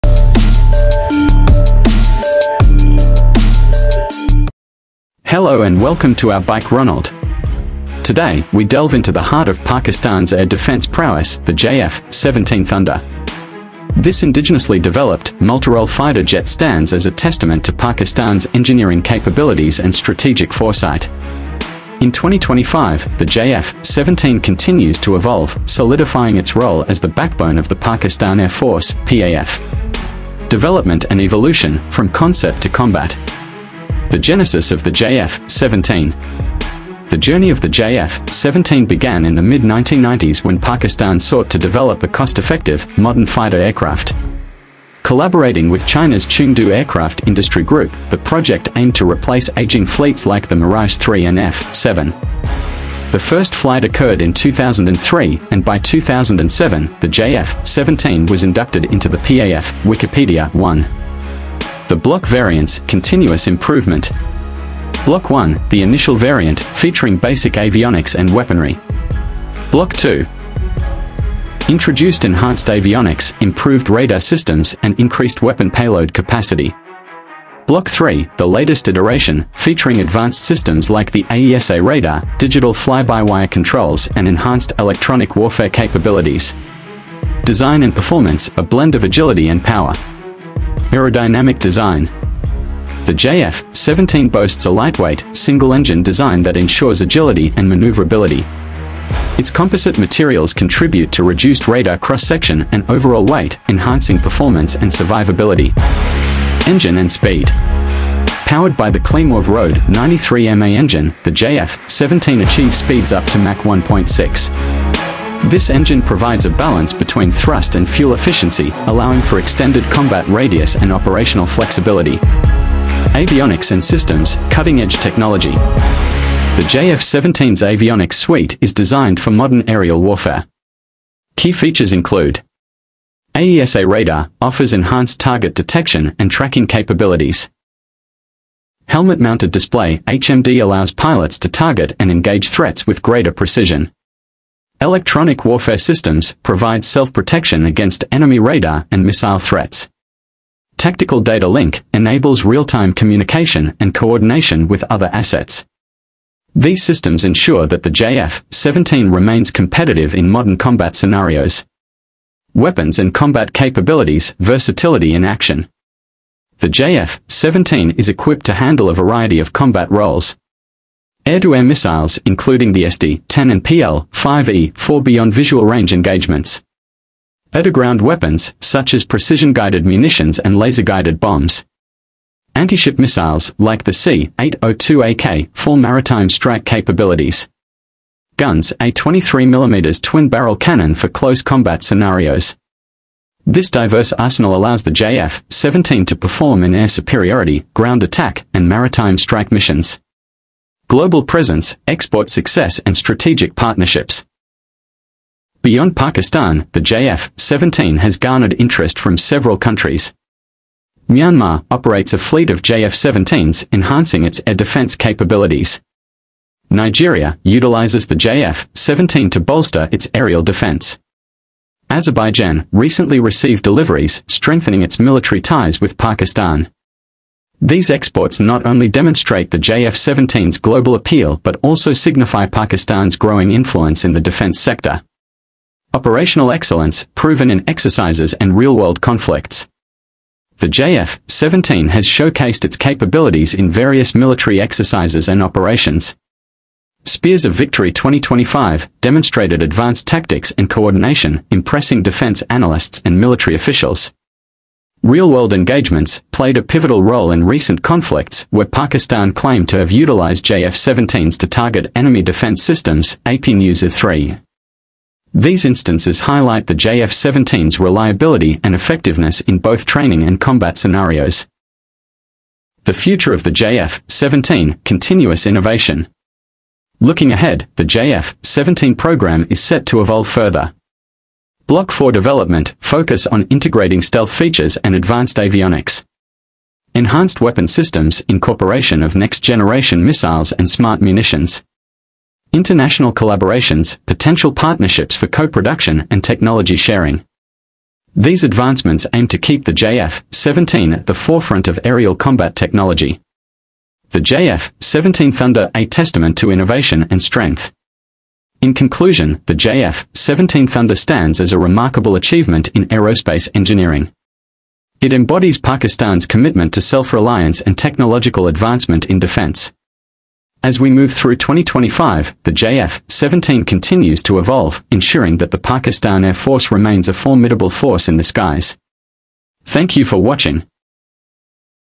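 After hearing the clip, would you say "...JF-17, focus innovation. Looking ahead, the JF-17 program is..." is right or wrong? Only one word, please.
wrong.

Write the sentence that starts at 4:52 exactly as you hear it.
International collaborations, potential partnerships for co-production and technology sharing.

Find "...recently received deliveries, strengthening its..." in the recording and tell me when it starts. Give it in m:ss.
3:42.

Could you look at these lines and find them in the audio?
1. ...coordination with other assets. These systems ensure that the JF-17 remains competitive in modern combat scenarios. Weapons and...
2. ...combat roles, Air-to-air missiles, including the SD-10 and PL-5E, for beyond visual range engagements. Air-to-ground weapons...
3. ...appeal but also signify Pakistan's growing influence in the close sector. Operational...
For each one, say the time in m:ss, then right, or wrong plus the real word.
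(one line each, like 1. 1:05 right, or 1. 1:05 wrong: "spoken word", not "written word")
1. 2:33 right
2. 2:49 right
3. 3:50 wrong: "defense", not "close".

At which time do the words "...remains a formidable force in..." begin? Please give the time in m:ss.
5:26.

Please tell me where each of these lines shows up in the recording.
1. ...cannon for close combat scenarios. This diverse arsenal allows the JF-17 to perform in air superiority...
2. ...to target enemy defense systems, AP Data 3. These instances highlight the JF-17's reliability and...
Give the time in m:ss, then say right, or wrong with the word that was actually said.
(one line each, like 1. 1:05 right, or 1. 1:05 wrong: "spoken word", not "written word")
1. 3:10 right
2. 4:21 wrong: "News", not "Data".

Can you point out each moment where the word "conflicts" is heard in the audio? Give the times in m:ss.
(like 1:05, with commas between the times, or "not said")
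3:58, 4:17.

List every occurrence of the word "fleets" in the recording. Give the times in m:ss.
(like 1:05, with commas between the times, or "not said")
0:49, 3:32.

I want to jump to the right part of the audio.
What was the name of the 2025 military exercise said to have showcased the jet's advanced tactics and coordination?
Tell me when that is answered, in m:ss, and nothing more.
4:07.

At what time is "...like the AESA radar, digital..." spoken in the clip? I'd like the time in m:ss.
1:20.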